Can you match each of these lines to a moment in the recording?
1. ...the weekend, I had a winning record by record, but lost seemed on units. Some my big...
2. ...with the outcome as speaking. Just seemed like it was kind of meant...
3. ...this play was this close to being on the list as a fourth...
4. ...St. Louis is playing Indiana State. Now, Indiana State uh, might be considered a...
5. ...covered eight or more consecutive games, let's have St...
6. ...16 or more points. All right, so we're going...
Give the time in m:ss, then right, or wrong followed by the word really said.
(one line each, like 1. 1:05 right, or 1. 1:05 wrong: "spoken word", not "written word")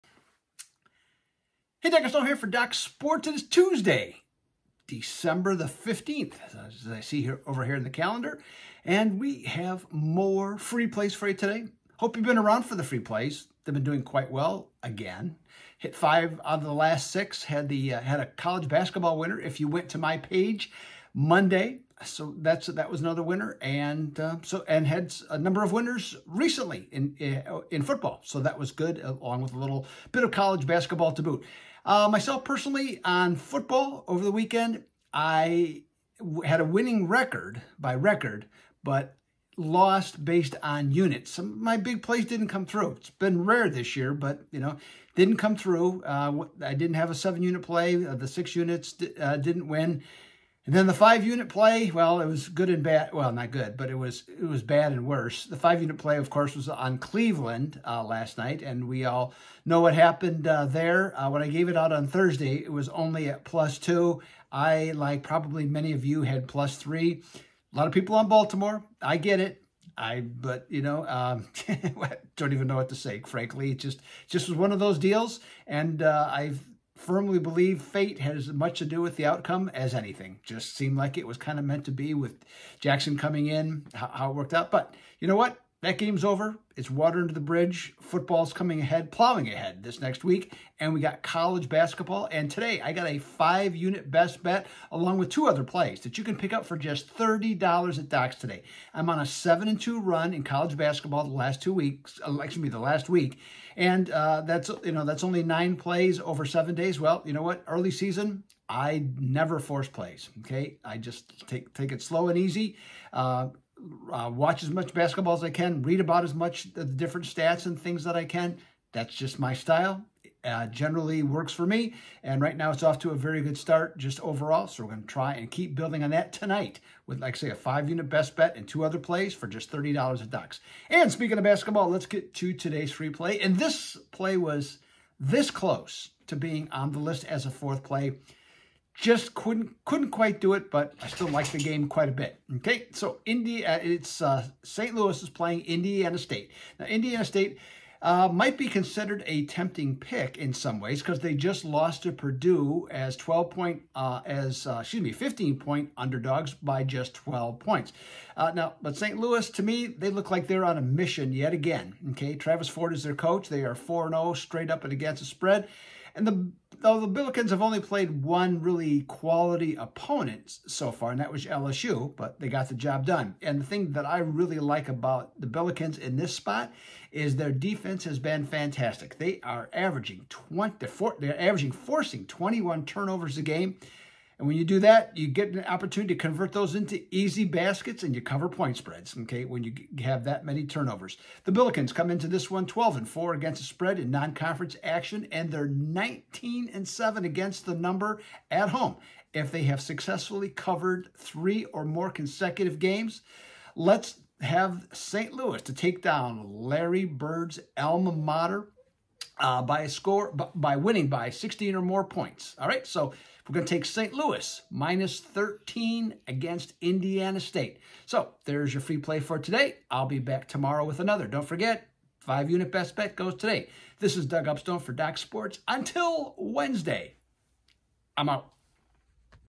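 1. 0:34 wrong: "based", not "seemed"
2. 1:19 wrong: "anything", not "speaking"
3. 2:13 right
4. 2:24 right
5. 3:20 wrong: "three", not "eight"
6. 3:31 right.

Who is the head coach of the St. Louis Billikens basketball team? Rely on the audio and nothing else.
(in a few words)
Travis Ford.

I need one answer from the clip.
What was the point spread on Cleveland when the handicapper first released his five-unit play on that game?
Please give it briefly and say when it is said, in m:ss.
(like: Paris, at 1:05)
+2, at 1:03.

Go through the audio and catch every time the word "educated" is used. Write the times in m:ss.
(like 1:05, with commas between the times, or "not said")
not said.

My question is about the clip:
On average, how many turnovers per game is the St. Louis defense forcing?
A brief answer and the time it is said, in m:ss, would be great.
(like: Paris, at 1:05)
21, at 3:02.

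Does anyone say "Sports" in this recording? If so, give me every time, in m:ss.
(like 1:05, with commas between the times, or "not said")
0:02, 3:45.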